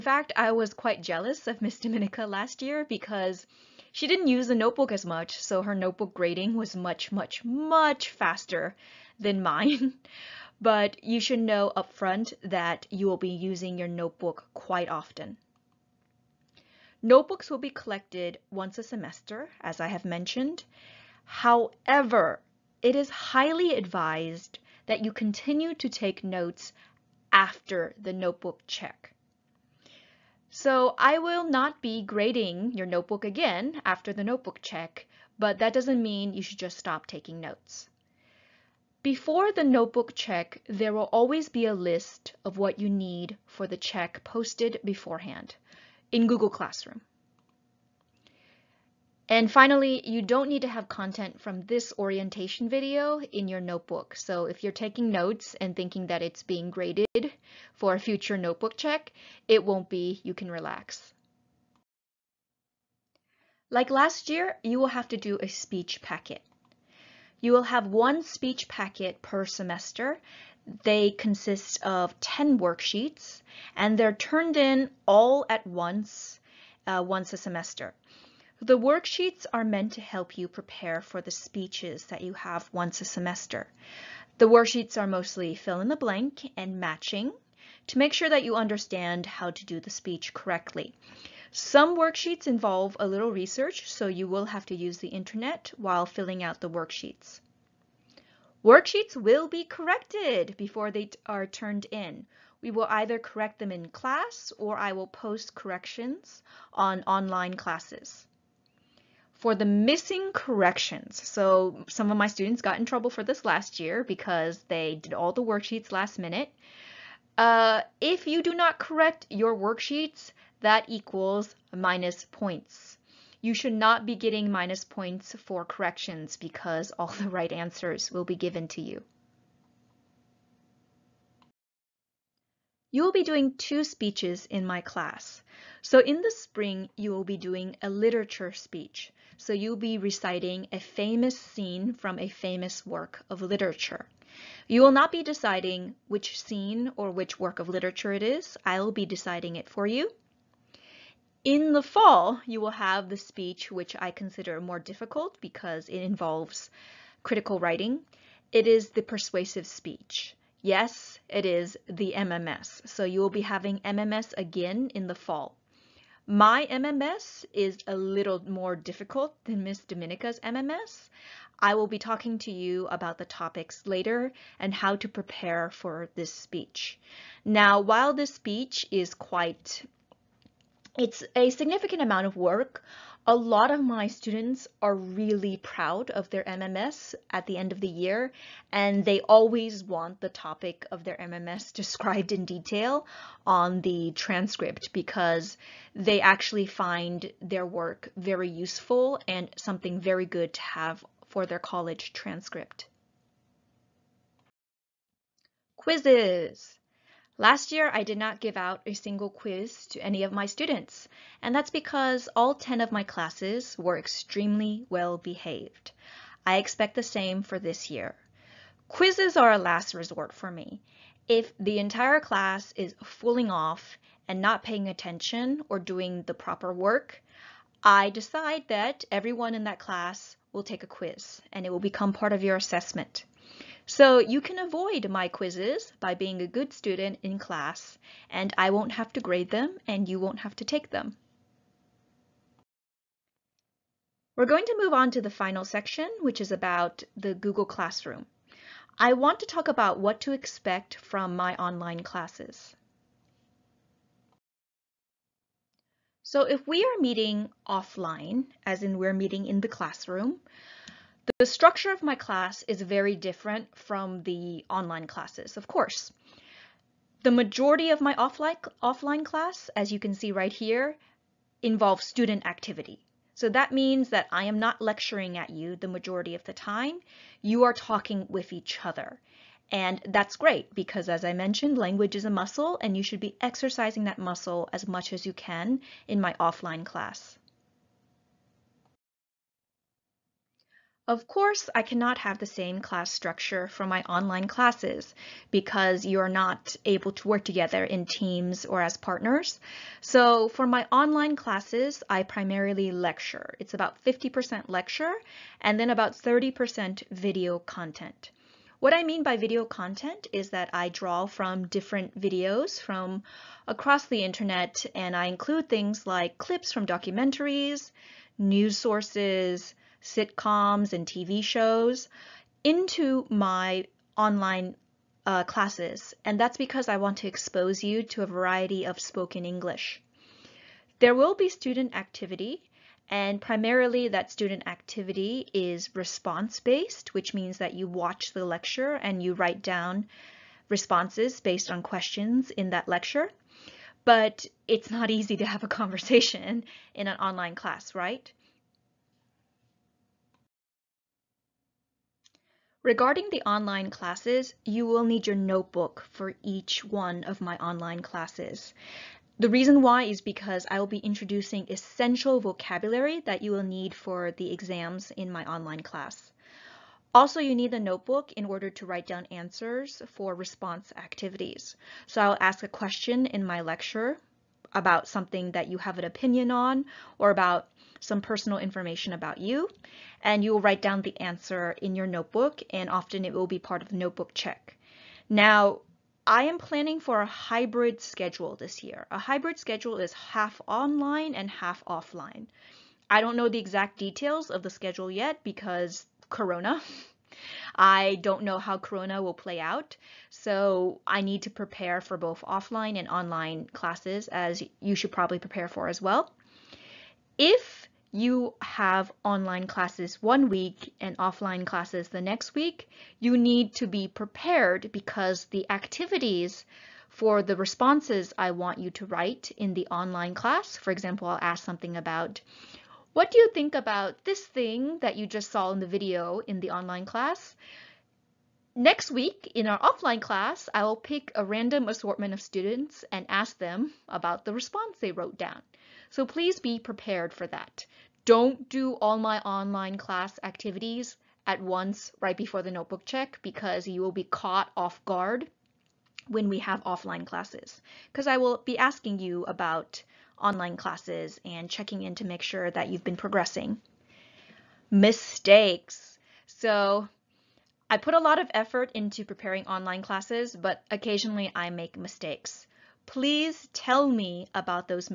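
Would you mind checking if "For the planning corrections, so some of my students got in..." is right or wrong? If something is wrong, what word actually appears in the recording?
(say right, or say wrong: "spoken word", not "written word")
wrong: "missing", not "planning".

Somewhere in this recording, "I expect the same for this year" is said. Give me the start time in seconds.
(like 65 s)
216 s.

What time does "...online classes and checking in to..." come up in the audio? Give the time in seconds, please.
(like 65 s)
450 s.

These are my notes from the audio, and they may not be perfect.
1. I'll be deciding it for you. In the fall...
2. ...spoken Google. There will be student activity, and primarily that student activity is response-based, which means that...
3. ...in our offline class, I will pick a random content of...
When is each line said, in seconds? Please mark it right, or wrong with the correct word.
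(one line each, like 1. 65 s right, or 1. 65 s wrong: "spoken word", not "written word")
1. 148 s right
2. 328 s wrong: "English", not "Google"
3. 429 s wrong: "assortment", not "content".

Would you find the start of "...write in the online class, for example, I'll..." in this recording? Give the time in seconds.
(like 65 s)
419 s.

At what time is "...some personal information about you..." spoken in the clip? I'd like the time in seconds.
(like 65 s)
377 s.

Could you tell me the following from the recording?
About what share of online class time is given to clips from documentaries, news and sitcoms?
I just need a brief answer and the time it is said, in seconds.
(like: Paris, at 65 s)
30%, at 306 s.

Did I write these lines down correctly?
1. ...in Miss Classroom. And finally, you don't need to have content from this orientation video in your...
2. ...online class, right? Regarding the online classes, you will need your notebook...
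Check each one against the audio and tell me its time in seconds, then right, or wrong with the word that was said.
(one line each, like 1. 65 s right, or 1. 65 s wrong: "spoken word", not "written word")
1. 46 s wrong: "Google", not "Miss"
2. 347 s right.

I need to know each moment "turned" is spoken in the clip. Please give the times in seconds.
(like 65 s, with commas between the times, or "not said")
74 s, 101 s.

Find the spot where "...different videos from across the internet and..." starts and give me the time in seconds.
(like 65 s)
311 s.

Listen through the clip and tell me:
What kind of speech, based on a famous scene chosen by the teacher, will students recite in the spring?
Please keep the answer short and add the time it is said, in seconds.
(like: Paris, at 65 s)
literature speech, at 137 s.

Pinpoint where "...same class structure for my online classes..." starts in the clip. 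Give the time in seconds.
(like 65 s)
292 s.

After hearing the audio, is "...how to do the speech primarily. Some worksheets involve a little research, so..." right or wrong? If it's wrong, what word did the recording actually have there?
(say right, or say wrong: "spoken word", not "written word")
wrong: "correctly", not "primarily".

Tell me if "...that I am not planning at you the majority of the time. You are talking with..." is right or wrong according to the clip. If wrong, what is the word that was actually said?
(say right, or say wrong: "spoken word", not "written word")
wrong: "lecturing", not "planning".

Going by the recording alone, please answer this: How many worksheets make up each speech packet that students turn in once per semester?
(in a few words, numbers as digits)
10.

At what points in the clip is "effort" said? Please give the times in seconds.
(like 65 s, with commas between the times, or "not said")
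458 s.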